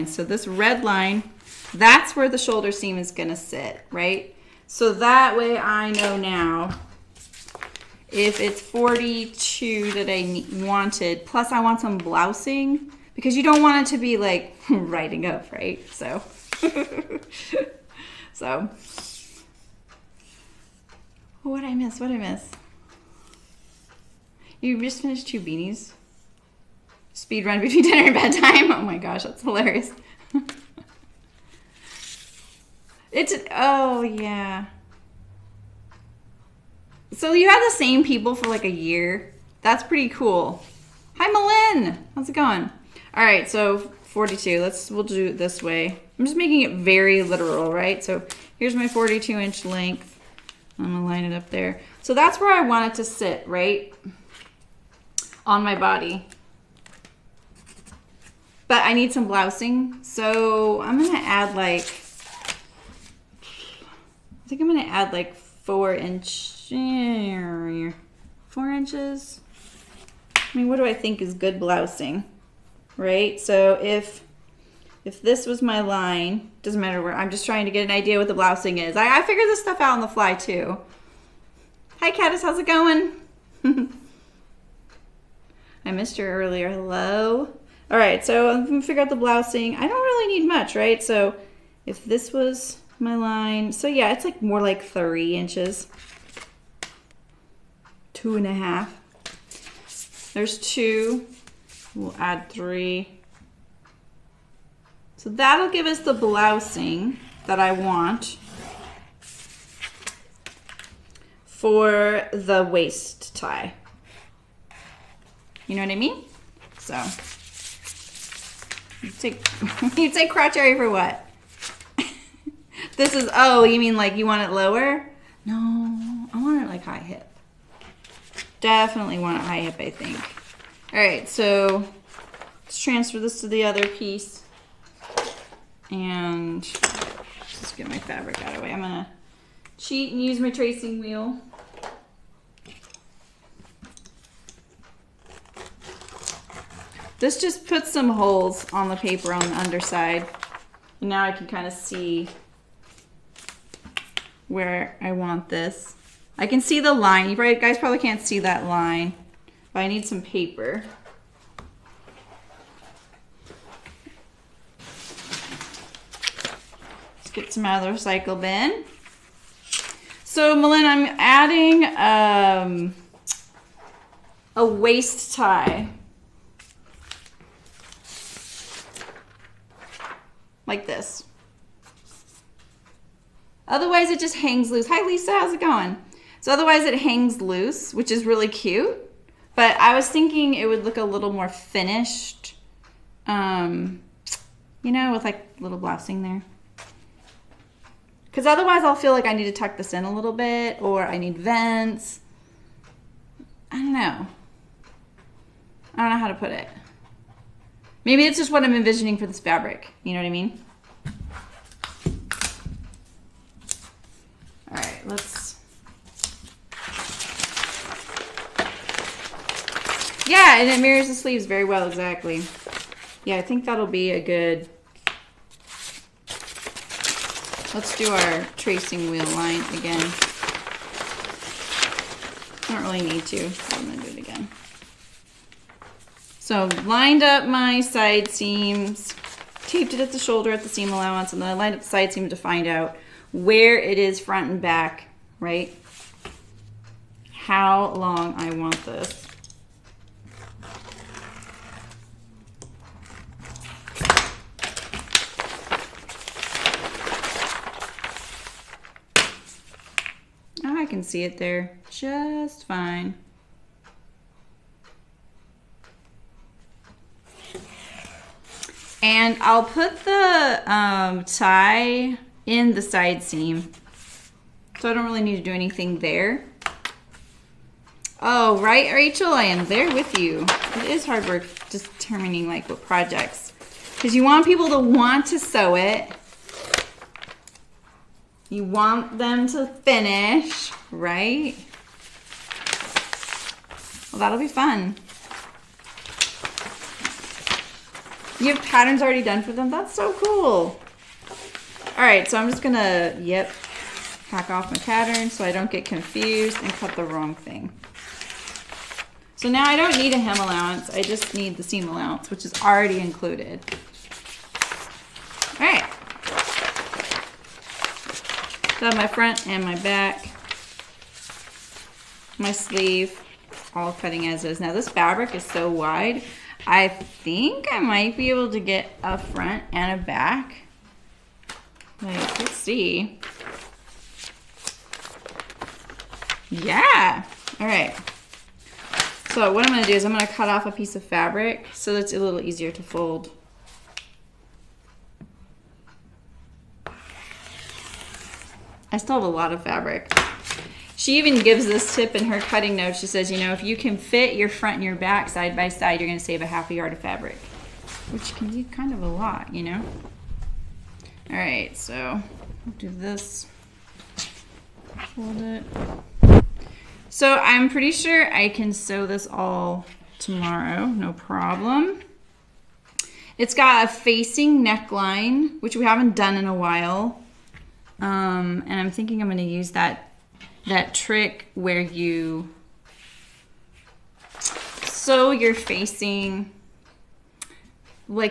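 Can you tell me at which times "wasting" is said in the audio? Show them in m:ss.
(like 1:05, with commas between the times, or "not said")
not said.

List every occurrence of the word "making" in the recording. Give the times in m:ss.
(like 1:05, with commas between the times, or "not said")
0:46.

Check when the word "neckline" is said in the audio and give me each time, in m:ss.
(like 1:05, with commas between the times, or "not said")
6:14.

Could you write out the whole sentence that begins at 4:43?
Because you want people to want to sew it.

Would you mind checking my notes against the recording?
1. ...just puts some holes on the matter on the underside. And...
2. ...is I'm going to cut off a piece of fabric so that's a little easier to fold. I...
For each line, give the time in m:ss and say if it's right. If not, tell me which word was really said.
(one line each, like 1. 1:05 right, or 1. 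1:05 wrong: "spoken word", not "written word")
1. 2:27 wrong: "paper", not "matter"
2. 5:39 right.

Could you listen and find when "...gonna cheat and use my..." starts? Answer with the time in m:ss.
2:18.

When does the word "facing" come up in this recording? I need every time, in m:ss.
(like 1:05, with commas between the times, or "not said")
6:13, 6:25.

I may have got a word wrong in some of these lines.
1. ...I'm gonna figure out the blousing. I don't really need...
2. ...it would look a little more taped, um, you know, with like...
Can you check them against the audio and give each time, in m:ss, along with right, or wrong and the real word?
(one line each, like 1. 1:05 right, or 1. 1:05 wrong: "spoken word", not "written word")
1. 1:28 right
2. 3:10 wrong: "finished", not "taped".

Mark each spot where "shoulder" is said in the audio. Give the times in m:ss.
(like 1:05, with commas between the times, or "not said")
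0:02, 4:00.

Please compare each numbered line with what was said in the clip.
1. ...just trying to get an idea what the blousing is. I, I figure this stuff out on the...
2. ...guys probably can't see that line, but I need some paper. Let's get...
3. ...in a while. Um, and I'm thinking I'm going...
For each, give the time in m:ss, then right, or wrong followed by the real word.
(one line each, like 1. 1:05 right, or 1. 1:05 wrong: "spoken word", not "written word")
1. 1:17 right
2. 2:37 right
3. 6:16 right.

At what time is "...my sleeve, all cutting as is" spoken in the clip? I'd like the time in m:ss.
5:22.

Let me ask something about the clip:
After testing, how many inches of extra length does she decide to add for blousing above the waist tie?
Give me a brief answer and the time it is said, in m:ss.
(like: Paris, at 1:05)
3, at 1:41.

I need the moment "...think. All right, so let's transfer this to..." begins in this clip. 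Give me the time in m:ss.
2:09.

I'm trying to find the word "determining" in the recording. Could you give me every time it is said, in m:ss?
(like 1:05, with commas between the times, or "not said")
4:41.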